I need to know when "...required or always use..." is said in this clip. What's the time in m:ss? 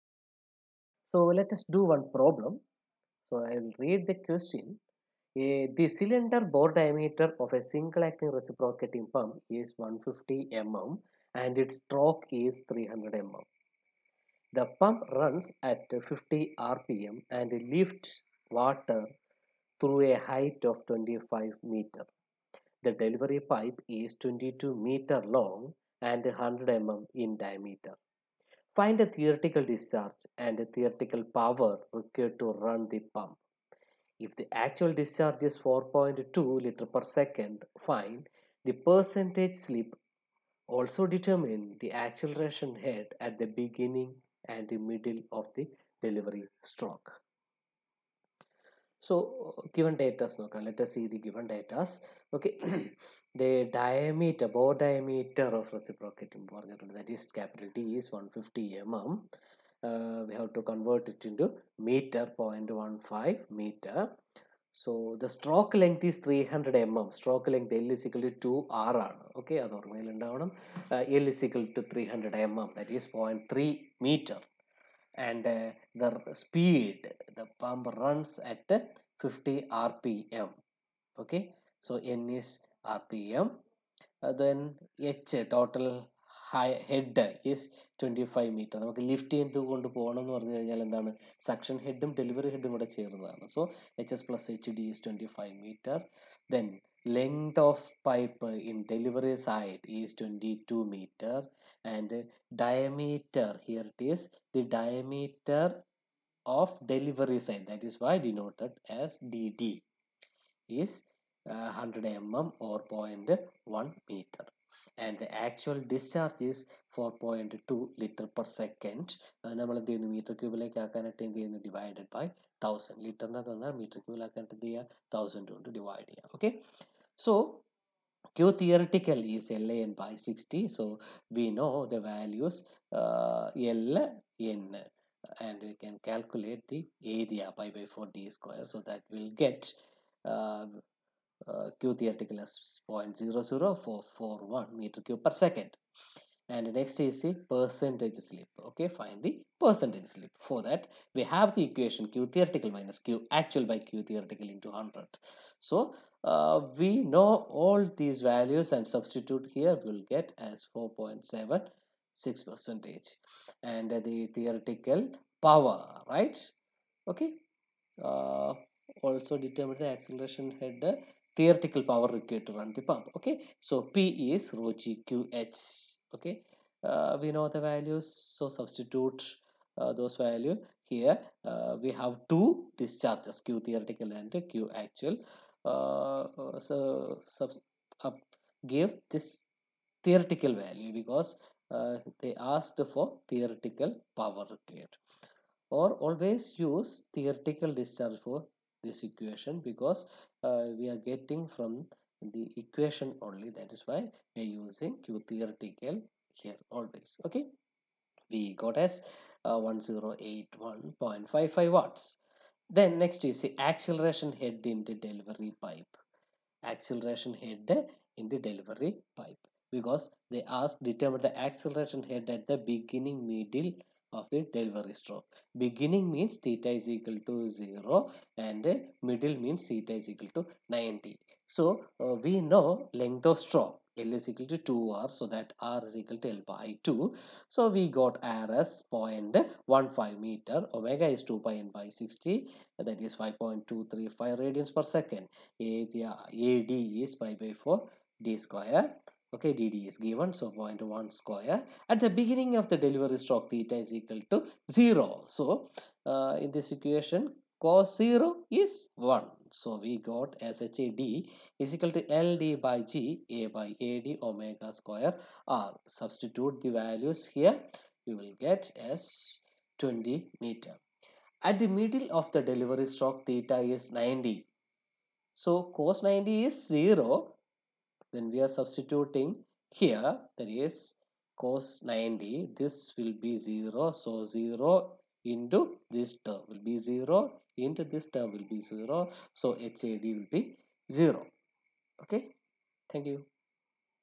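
3:14.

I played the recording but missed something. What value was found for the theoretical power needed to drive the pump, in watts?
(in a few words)
1081.55 watts.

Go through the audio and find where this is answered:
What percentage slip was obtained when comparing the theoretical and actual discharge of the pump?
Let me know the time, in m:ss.
2:40.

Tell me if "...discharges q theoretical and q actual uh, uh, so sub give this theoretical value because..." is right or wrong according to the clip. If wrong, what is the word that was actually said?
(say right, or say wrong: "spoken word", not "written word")
right.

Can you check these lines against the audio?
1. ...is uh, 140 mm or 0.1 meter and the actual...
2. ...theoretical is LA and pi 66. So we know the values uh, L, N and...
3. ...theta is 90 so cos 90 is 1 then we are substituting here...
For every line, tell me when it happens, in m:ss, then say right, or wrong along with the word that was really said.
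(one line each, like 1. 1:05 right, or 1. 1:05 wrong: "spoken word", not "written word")
1. 1:50 wrong: "100", not "140"
2. 2:08 wrong: "60", not "66"
3. 4:33 wrong: "0", not "1".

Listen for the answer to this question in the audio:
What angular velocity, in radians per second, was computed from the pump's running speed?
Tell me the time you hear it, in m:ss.
4:03.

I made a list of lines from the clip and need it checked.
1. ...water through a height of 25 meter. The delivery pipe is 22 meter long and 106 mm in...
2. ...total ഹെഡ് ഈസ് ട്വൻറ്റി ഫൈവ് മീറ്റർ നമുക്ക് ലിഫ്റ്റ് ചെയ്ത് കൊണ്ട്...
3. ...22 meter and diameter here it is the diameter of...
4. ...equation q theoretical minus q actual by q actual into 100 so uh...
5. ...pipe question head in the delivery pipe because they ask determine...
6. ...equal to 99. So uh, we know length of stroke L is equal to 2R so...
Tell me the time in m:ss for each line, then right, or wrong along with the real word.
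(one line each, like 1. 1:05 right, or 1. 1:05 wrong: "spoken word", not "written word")
1. 0:18 wrong: "100", not "106"
2. 1:25 right
3. 1:40 right
4. 2:31 wrong: "theoretical", not "actual"
5. 3:35 wrong: "acceleration", not "question"
6. 3:50 wrong: "90", not "99".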